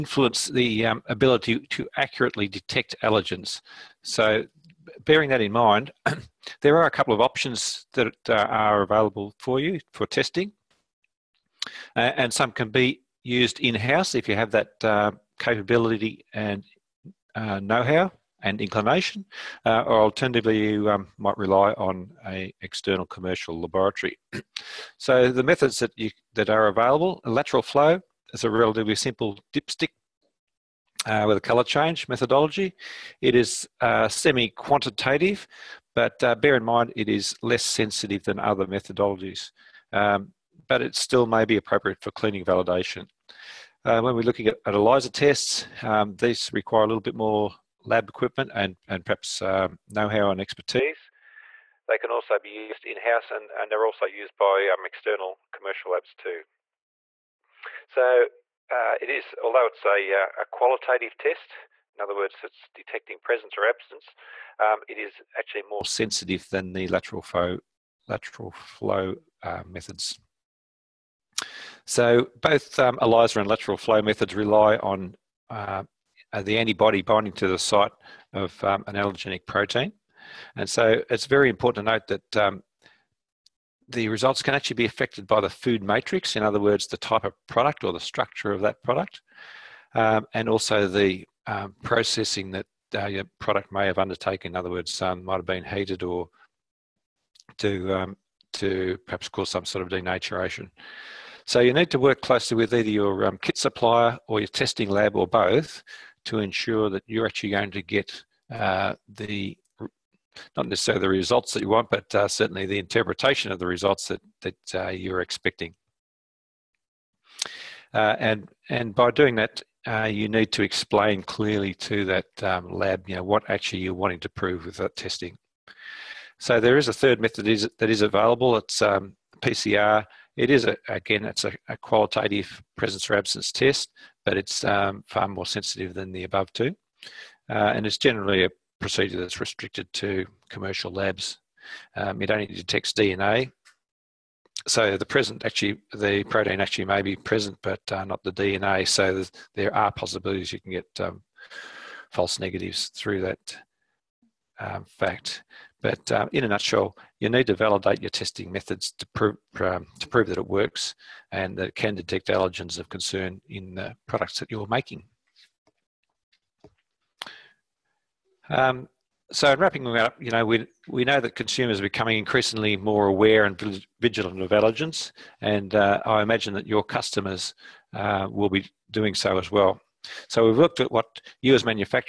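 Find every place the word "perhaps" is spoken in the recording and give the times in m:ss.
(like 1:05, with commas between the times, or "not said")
0:49, 1:39.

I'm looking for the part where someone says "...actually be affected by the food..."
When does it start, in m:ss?
1:24.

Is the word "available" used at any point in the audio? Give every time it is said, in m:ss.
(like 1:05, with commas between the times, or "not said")
0:08, 0:26, 2:08.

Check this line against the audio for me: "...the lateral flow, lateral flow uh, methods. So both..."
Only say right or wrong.
right.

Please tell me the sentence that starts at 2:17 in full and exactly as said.
Uh, and it's generally a procedure that's restricted to commercial labs.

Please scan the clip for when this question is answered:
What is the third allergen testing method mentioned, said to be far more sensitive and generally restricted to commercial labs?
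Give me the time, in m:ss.
2:09.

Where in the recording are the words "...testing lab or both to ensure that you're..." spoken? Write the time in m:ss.
1:44.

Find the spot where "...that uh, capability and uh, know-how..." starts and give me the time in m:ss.
0:14.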